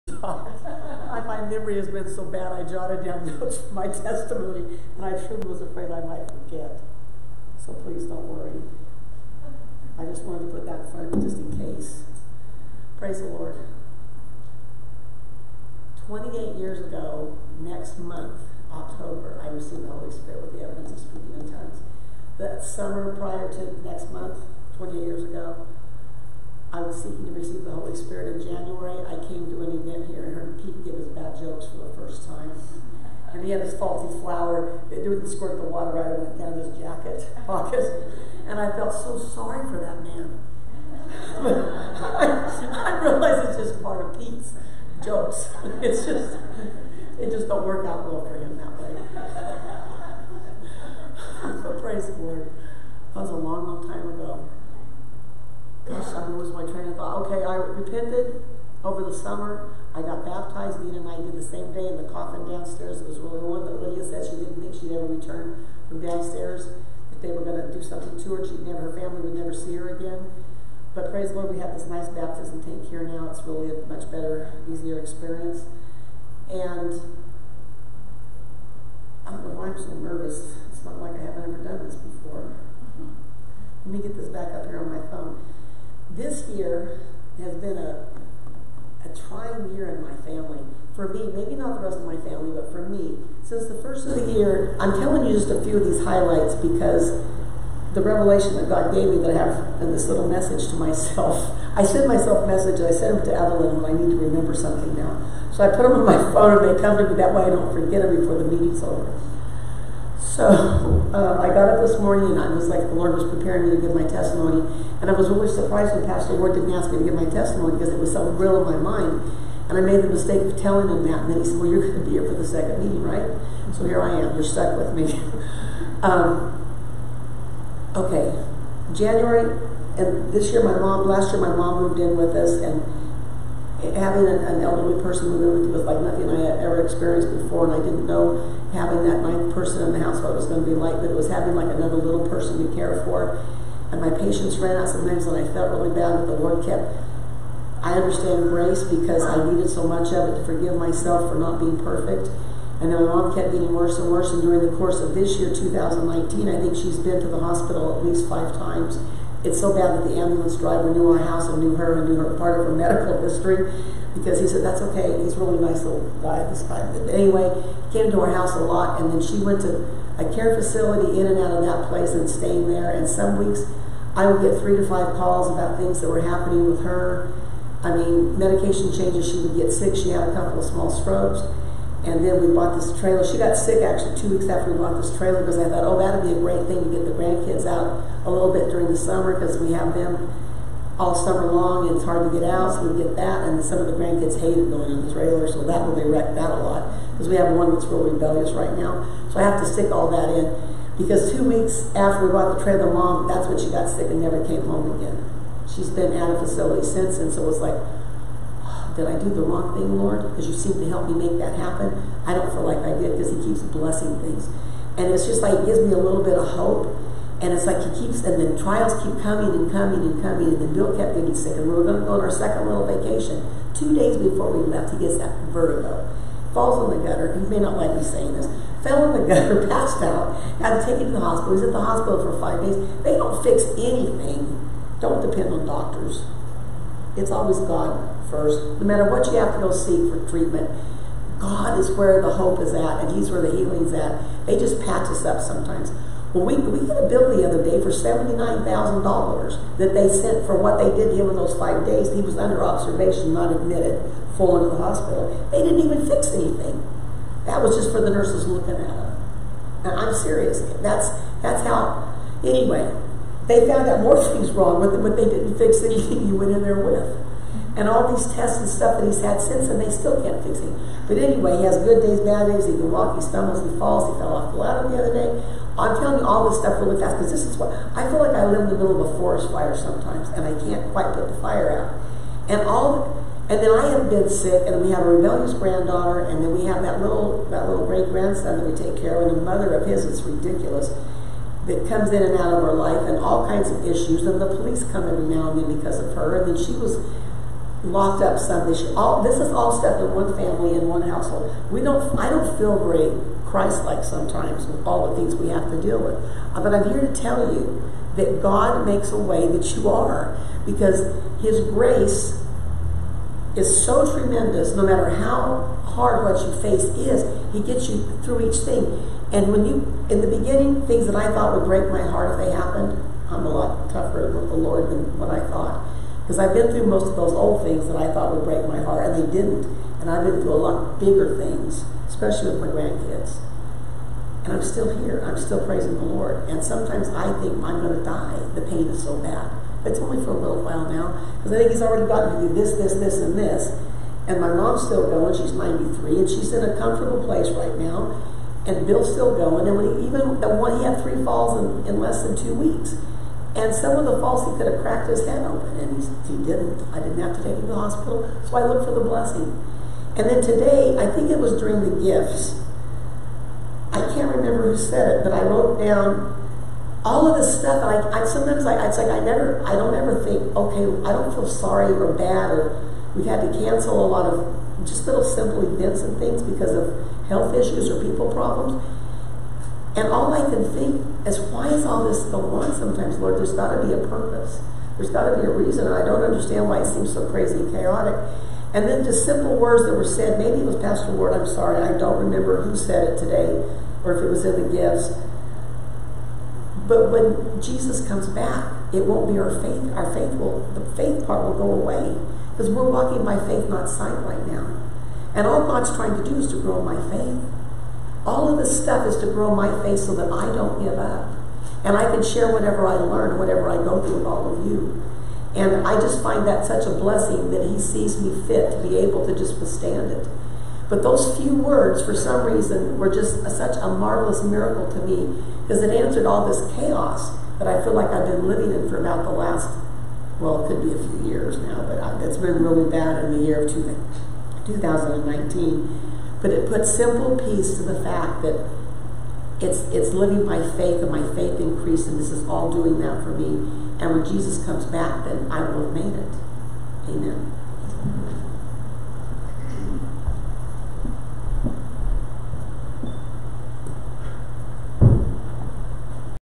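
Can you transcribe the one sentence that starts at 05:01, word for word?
We don't, I don't feel very Christ-like sometimes with all the things we have to deal with.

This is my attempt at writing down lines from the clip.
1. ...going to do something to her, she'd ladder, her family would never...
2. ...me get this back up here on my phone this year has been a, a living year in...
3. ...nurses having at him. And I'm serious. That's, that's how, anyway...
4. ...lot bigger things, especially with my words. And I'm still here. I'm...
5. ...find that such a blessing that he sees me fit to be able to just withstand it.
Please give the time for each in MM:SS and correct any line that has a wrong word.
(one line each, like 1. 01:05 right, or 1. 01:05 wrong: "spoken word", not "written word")
1. 01:07 wrong: "never", not "ladder"
2. 01:23 wrong: "trying", not "living"
3. 04:18 wrong: "looking", not "having"
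4. 05:30 wrong: "grandkids", not "words"
5. 06:56 right.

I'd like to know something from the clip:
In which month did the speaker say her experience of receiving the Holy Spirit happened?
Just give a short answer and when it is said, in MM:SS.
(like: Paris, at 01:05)
October, at 00:18.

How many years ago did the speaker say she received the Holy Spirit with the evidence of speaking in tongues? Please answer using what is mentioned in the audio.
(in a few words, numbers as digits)
28.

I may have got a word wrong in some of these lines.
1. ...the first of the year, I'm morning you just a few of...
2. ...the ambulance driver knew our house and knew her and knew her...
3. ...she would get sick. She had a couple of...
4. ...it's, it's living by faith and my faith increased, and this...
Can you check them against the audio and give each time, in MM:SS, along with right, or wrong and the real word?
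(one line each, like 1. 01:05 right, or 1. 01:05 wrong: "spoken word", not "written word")
1. 01:33 wrong: "telling", not "morning"
2. 02:40 right
3. 02:59 right
4. 07:19 right.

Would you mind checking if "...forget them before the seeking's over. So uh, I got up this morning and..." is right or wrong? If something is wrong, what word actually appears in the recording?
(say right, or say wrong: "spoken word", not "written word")
wrong: "meeting", not "seeking".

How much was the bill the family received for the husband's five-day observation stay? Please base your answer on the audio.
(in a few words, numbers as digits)
$79,000.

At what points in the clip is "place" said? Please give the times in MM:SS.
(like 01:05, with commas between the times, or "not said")
02:51, 05:47.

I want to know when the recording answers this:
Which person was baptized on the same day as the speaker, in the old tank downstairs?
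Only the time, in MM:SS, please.
01:00.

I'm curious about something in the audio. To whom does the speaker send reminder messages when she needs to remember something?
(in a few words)
Evelyn.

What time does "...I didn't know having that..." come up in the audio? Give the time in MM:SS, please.
02:17.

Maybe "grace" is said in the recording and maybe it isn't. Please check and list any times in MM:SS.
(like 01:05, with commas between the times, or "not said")
02:28, 05:11.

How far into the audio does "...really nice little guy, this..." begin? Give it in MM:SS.
02:45.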